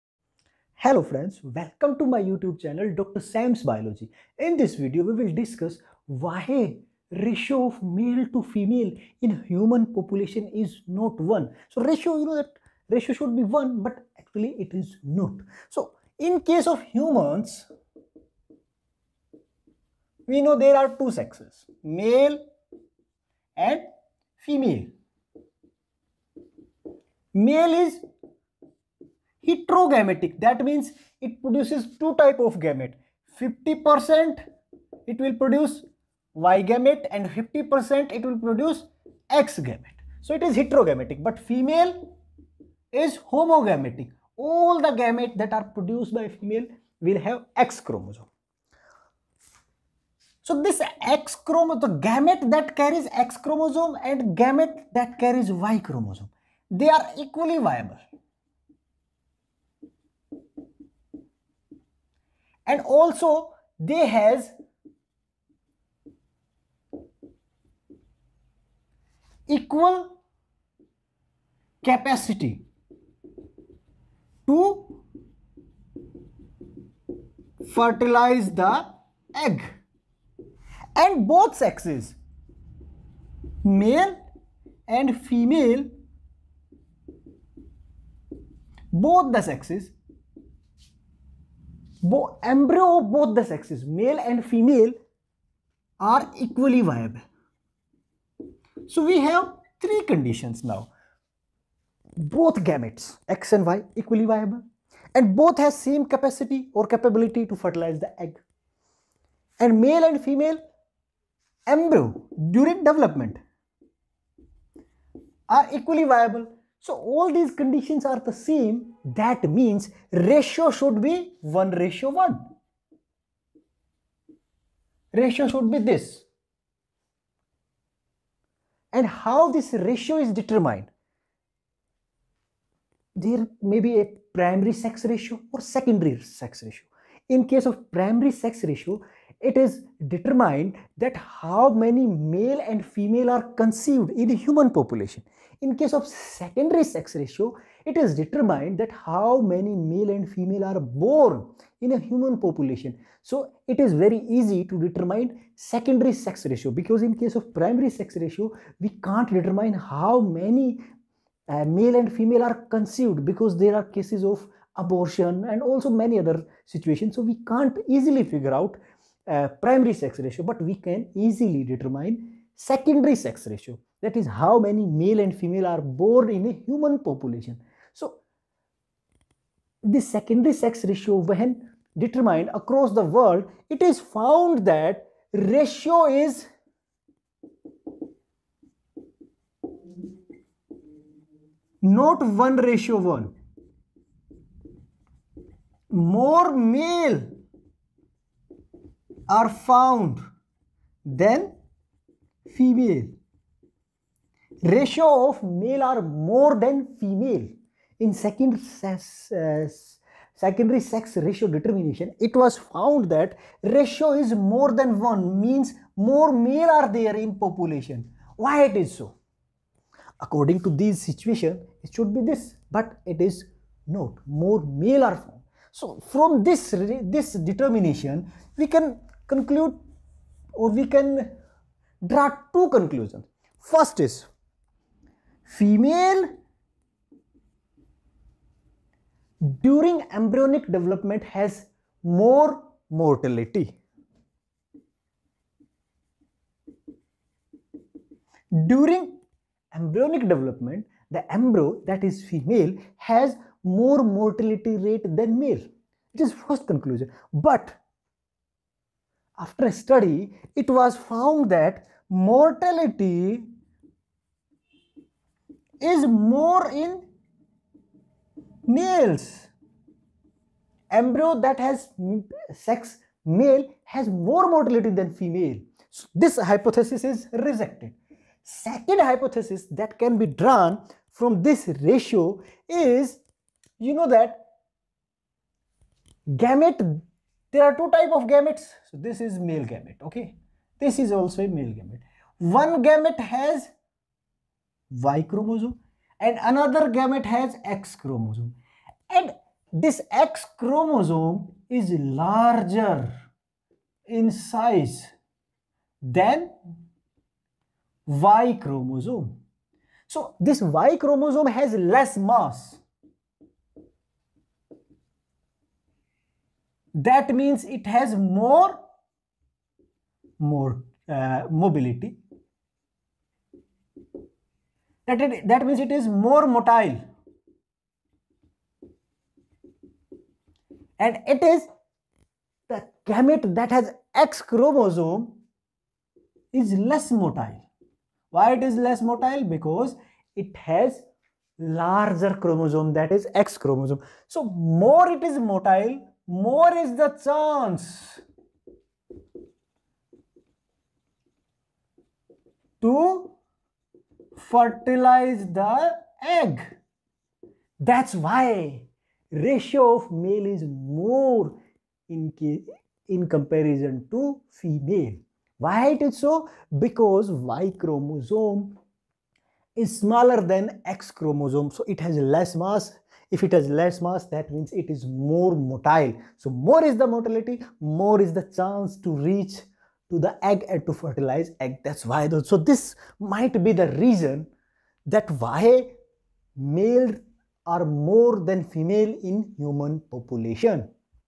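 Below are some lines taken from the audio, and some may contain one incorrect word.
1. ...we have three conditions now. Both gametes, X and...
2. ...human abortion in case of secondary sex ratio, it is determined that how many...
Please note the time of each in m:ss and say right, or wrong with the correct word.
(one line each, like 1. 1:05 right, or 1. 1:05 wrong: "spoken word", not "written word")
1. 1:39 right
2. 2:24 wrong: "population", not "abortion".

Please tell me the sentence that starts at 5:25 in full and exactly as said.
That, it, that means it is more motile.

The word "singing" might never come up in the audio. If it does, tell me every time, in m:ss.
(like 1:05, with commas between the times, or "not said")
not said.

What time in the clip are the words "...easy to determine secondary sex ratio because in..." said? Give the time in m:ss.
2:34.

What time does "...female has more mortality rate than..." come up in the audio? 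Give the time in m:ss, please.
4:12.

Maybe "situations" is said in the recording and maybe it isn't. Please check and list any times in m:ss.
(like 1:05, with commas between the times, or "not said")
2:46, 3:41.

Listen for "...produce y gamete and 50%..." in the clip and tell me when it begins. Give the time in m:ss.
0:35.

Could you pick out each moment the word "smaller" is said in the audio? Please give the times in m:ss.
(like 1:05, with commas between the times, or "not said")
6:09.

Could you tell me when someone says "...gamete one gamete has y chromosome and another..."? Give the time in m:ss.
4:51.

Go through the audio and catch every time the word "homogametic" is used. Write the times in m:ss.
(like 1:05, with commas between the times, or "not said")
0:43.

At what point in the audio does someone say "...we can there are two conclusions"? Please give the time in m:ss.
3:50.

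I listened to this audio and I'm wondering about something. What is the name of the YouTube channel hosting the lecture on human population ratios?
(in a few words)
Dr. Sam's Biology.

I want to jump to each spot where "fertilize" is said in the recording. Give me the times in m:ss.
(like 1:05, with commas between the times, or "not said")
1:17, 1:47, 5:54, 6:20.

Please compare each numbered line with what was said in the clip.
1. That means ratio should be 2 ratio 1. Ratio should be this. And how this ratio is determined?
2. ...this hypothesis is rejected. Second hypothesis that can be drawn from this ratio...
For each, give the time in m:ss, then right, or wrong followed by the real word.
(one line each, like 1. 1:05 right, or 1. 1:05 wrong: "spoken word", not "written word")
1. 1:59 wrong: "1", not "2"
2. 4:36 right.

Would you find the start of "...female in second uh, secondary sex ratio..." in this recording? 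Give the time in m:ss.
3:26.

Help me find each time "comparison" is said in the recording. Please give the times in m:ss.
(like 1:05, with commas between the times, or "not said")
6:03.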